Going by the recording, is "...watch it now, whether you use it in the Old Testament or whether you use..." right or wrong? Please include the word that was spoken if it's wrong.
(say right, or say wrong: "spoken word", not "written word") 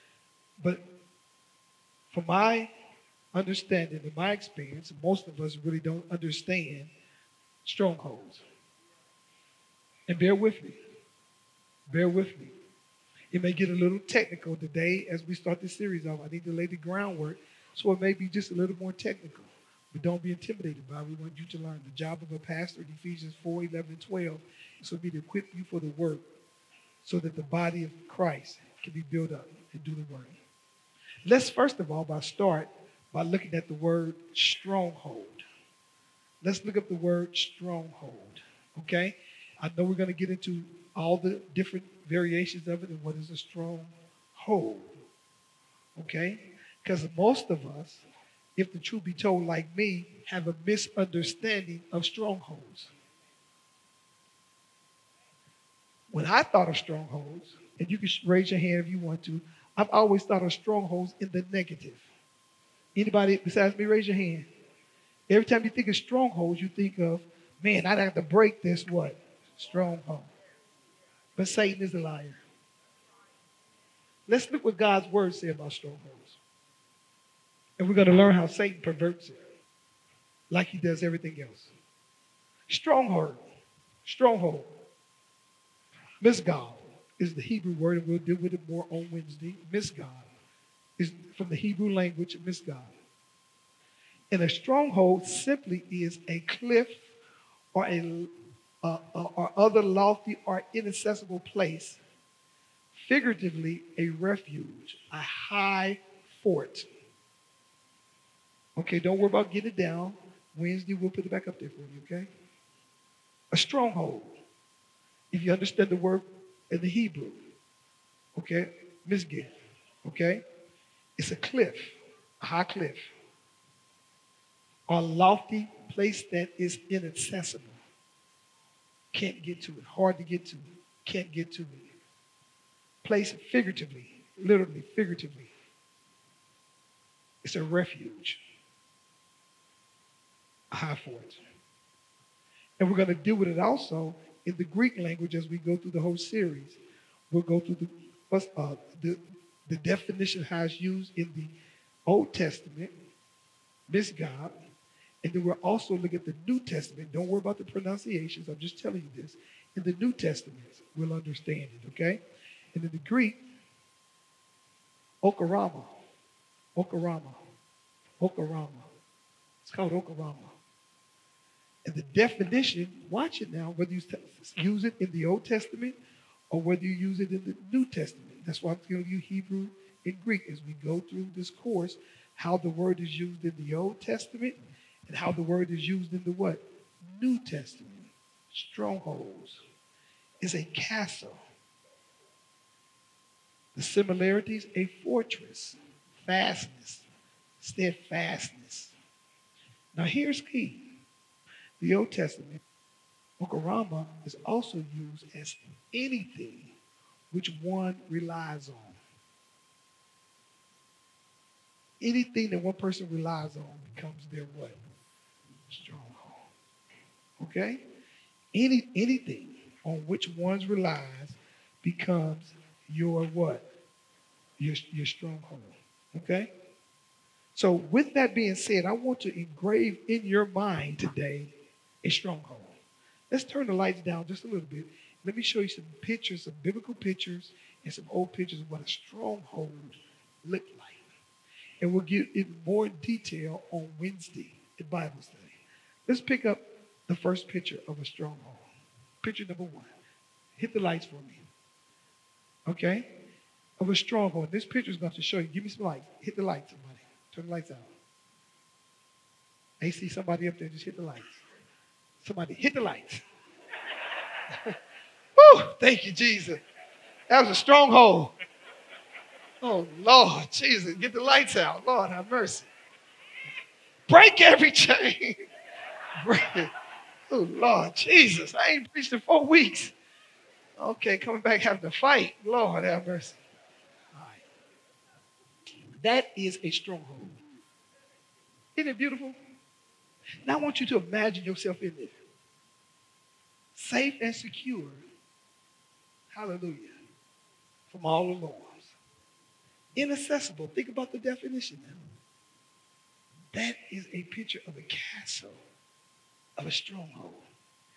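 right.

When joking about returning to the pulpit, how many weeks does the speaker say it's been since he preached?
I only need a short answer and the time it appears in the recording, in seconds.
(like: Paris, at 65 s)
4, at 279 s.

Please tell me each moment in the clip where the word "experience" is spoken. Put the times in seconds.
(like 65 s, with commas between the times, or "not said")
4 s.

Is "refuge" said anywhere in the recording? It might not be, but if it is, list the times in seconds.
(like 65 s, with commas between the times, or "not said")
104 s, 137 s.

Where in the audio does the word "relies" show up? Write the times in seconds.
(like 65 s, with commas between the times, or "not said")
208 s, 213 s, 220 s.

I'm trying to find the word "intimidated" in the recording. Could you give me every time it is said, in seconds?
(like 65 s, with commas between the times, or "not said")
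20 s.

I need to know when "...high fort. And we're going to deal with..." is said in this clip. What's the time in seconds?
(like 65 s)
140 s.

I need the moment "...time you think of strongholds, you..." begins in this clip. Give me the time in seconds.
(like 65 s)
65 s.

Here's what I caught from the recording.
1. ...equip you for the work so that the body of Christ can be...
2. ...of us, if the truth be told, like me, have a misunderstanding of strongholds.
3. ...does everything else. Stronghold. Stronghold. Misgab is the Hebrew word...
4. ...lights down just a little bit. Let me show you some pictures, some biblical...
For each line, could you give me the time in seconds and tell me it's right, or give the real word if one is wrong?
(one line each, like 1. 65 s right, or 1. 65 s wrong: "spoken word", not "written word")
1. 25 s right
2. 47 s right
3. 80 s right
4. 233 s right.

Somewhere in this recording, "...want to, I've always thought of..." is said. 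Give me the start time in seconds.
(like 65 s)
58 s.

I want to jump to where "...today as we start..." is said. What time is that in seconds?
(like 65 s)
14 s.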